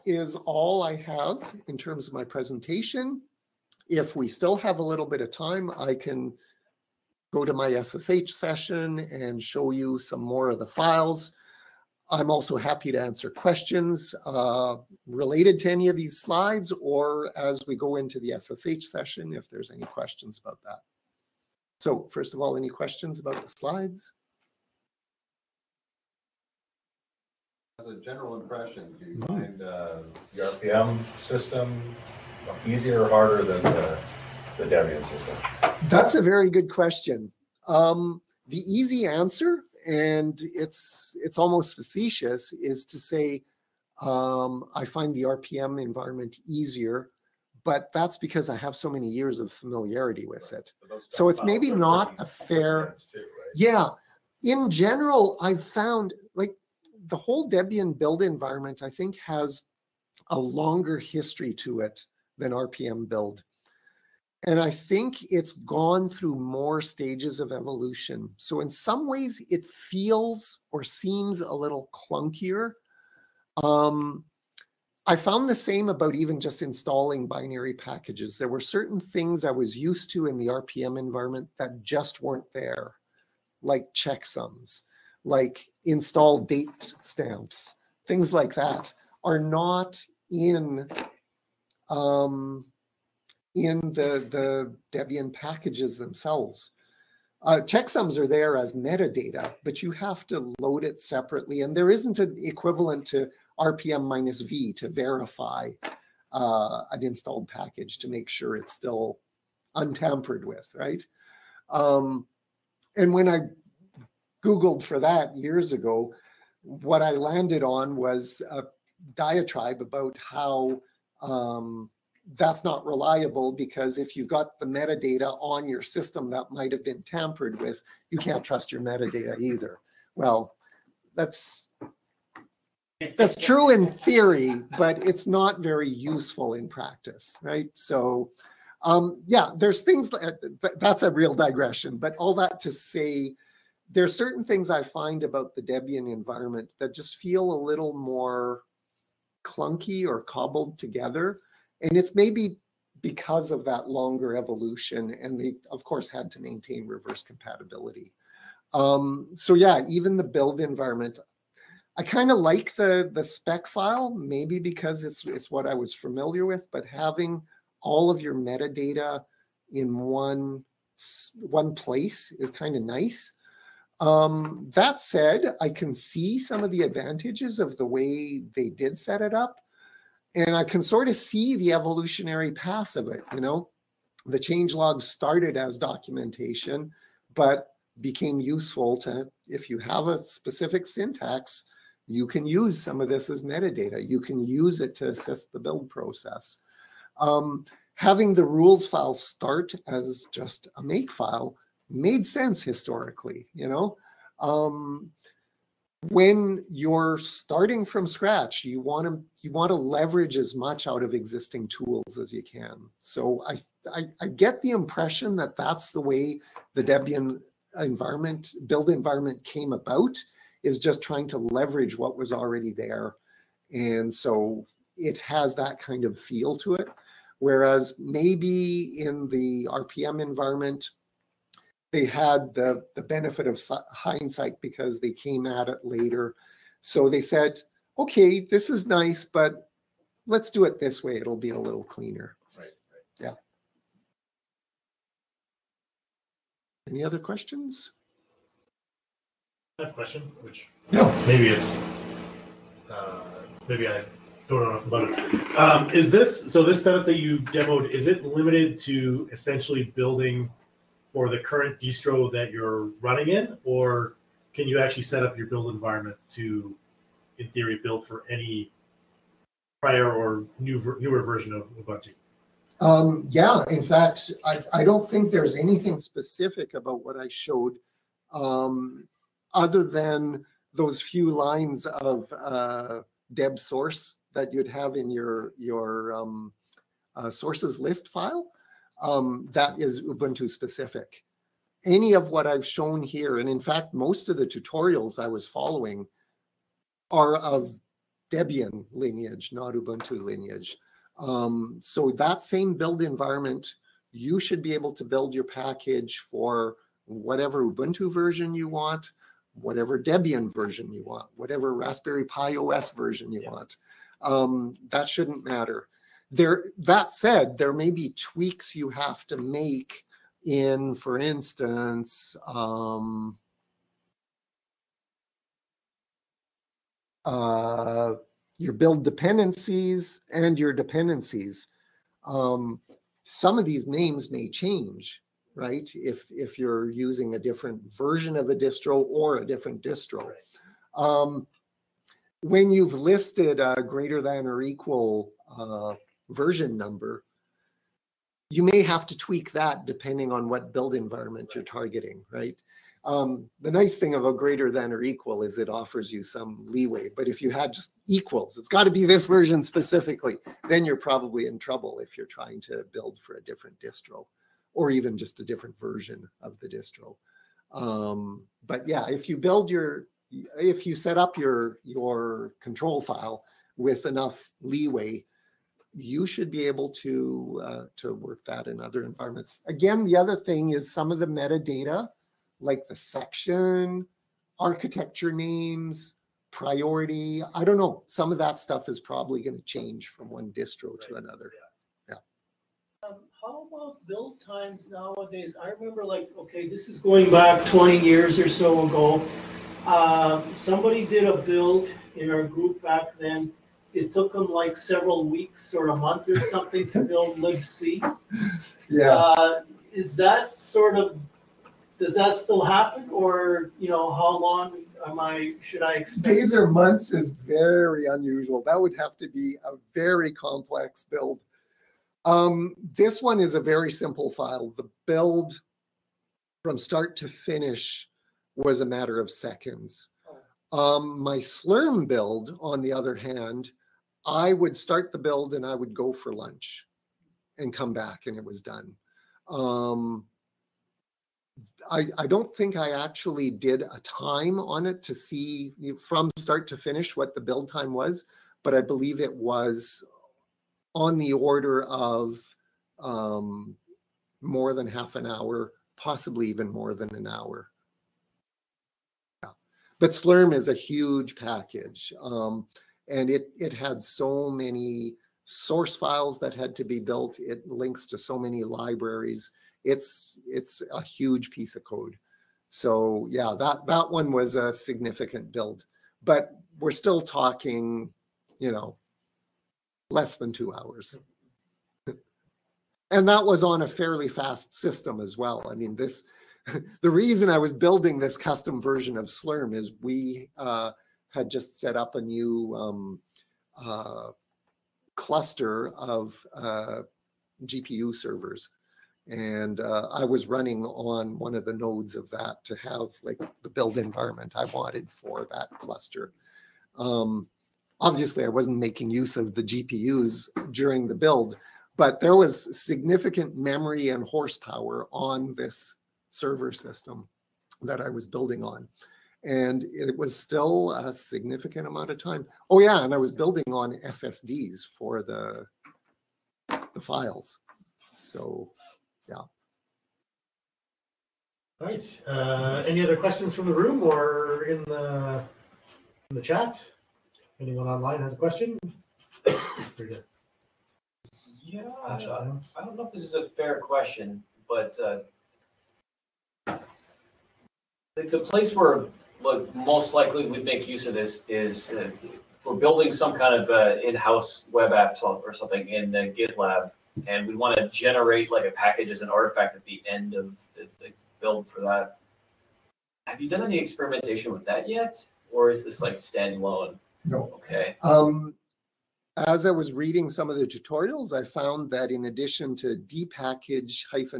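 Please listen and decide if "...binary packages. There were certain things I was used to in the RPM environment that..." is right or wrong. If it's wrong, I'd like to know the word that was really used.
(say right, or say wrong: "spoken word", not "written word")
right.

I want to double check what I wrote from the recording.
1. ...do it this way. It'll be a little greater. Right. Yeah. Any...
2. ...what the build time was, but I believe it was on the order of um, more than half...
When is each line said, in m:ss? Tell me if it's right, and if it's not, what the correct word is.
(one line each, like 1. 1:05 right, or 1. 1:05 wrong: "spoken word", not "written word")
1. 4:00 wrong: "cleaner", not "greater"
2. 7:27 right.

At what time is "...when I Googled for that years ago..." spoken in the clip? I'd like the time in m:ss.
1:53.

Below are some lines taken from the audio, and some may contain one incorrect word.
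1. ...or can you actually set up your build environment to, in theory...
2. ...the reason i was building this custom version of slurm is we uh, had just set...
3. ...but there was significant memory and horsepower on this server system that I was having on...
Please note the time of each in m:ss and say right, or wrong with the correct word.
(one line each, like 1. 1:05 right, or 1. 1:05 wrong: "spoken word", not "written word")
1. 4:23 right
2. 8:07 right
3. 8:31 wrong: "building", not "having".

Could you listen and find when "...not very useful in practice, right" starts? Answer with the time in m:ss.
2:15.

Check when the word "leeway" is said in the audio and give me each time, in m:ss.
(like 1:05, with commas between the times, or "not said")
5:56, 6:14.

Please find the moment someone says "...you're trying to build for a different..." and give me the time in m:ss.
6:02.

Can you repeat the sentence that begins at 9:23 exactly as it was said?
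Have you done any experimentation with that yet, or is this like standalone?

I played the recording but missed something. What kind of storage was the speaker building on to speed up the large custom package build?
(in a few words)
SSDs.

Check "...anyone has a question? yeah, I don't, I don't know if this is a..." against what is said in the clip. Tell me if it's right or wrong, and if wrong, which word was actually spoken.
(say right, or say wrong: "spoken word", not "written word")
wrong: "online", not "anyone".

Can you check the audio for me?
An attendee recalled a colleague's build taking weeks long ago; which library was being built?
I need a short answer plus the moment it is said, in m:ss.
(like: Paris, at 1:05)
libc, at 6:47.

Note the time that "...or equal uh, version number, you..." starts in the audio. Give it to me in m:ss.
5:44.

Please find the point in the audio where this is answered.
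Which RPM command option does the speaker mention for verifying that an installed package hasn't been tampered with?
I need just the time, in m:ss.
1:43.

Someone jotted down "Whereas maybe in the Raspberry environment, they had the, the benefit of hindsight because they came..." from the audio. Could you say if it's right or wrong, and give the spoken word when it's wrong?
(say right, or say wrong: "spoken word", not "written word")
wrong: "RPM", not "Raspberry".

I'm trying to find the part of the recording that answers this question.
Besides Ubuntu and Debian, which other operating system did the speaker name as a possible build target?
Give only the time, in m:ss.
5:11.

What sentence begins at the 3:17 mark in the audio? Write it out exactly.
Um, having the rules file start as just a make file made sense historically, you know?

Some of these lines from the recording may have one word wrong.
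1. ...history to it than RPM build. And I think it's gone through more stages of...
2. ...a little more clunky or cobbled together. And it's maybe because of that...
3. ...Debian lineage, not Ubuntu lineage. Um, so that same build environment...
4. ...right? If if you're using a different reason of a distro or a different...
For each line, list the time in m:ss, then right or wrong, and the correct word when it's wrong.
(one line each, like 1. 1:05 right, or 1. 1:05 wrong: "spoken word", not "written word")
1. 1:00 right
2. 2:27 right
3. 4:58 right
4. 5:35 wrong: "version", not "reason".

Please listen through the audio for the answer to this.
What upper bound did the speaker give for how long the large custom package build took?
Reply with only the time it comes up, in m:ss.
8:00.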